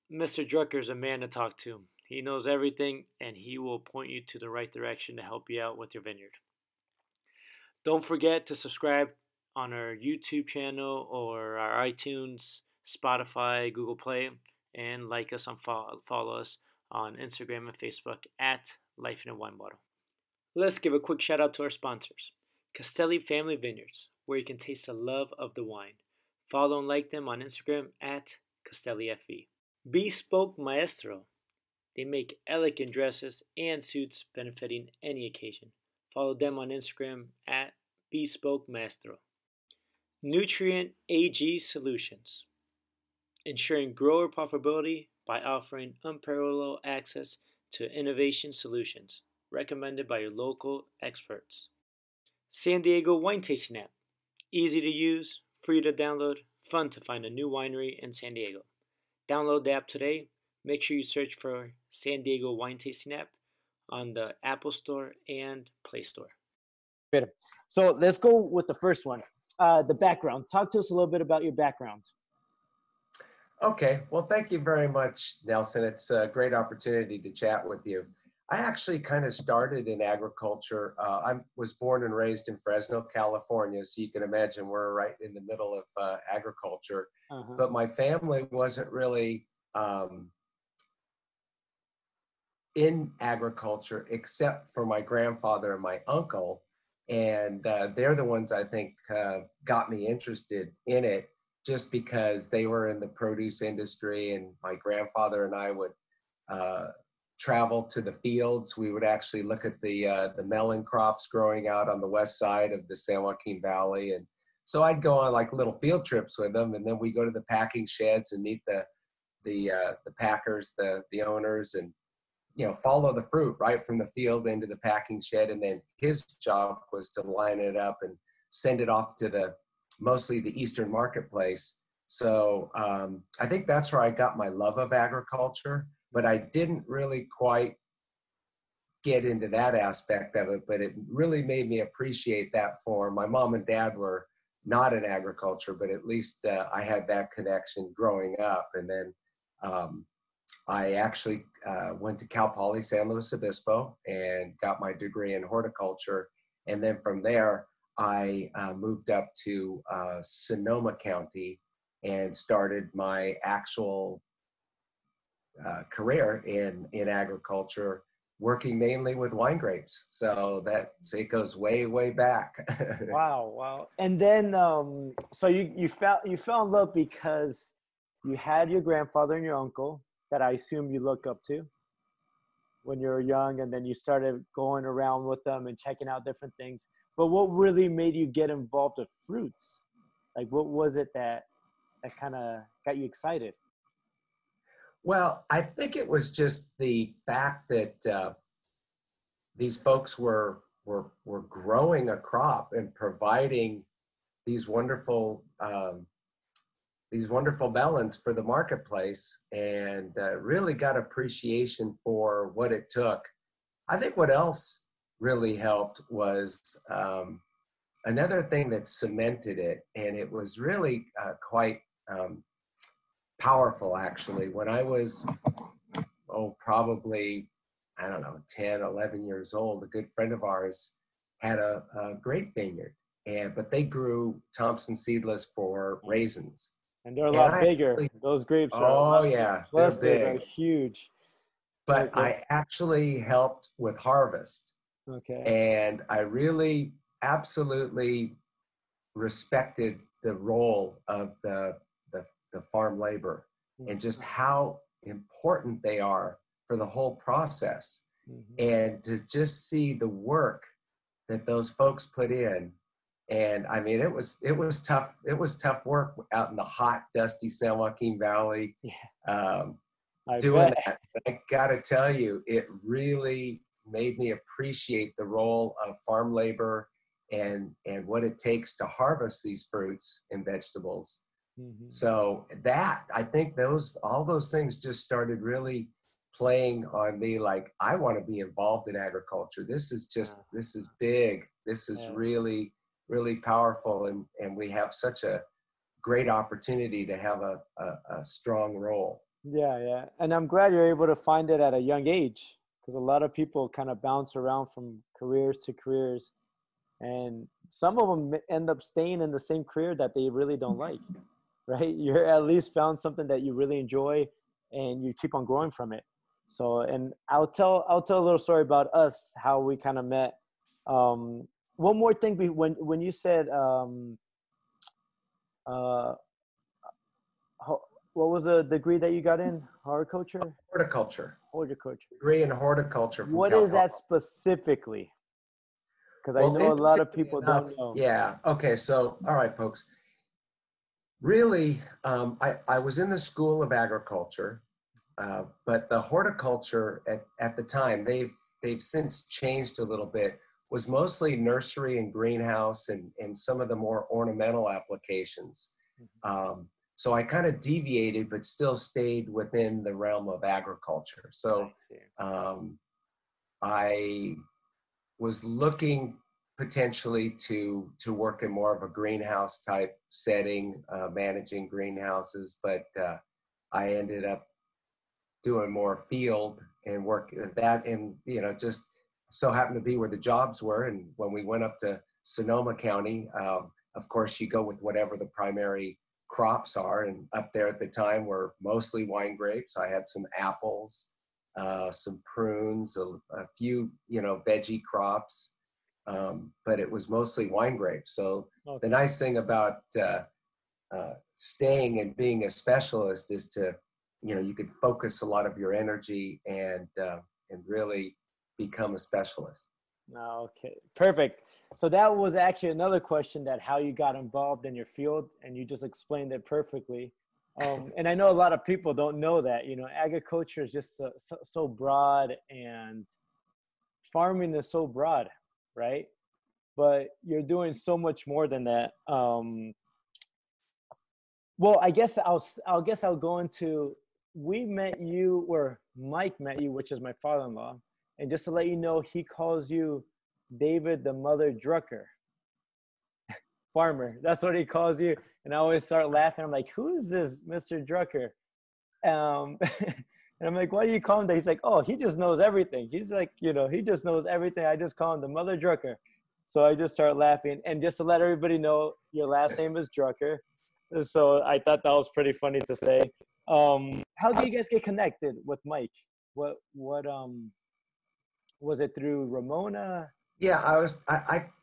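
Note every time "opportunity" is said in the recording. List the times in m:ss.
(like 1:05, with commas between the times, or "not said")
1:16, 4:56.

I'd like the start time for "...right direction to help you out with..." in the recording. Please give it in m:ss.
0:04.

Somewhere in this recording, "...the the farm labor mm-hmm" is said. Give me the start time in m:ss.
4:11.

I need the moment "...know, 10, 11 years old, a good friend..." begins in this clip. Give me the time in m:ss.
3:48.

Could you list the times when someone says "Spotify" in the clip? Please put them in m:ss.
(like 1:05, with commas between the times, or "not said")
0:12.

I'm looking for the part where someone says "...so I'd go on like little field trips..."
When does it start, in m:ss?
1:54.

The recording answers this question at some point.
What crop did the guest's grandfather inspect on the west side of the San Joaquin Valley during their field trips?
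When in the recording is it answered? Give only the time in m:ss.
1:50.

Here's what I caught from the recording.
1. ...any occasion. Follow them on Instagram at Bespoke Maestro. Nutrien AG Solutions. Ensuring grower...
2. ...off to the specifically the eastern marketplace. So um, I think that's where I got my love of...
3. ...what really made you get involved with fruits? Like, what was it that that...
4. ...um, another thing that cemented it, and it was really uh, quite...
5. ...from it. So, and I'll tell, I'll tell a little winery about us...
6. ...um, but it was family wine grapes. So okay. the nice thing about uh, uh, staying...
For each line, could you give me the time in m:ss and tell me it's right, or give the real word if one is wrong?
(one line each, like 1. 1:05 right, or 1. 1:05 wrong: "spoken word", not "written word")
1. 0:35 right
2. 2:08 wrong: "mostly", not "specifically"
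3. 3:07 right
4. 3:36 right
5. 5:15 wrong: "story", not "winery"
6. 6:36 wrong: "mostly", not "family".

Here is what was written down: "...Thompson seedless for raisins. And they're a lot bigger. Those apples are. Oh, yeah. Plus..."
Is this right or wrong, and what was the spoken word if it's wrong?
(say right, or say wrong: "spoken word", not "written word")
wrong: "grapes", not "apples".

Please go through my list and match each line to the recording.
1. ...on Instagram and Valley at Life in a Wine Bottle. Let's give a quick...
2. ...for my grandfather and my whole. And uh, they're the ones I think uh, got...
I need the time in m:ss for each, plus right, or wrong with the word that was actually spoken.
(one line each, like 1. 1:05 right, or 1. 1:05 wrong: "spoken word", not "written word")
1. 0:16 wrong: "Facebook", not "Valley"
2. 1:34 wrong: "uncle", not "whole".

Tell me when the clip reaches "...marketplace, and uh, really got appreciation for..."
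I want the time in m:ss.
3:28.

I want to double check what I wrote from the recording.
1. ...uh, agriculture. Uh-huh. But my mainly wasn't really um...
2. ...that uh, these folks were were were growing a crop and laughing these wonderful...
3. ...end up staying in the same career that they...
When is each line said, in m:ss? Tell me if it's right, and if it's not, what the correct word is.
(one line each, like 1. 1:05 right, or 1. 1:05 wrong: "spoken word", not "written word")
1. 1:26 wrong: "family", not "mainly"
2. 3:17 wrong: "providing", not "laughing"
3. 5:08 right.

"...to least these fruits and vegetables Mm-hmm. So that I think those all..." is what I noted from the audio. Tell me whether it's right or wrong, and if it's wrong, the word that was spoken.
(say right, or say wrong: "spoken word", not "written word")
wrong: "harvest", not "least".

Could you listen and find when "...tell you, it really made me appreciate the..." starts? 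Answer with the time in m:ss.
4:31.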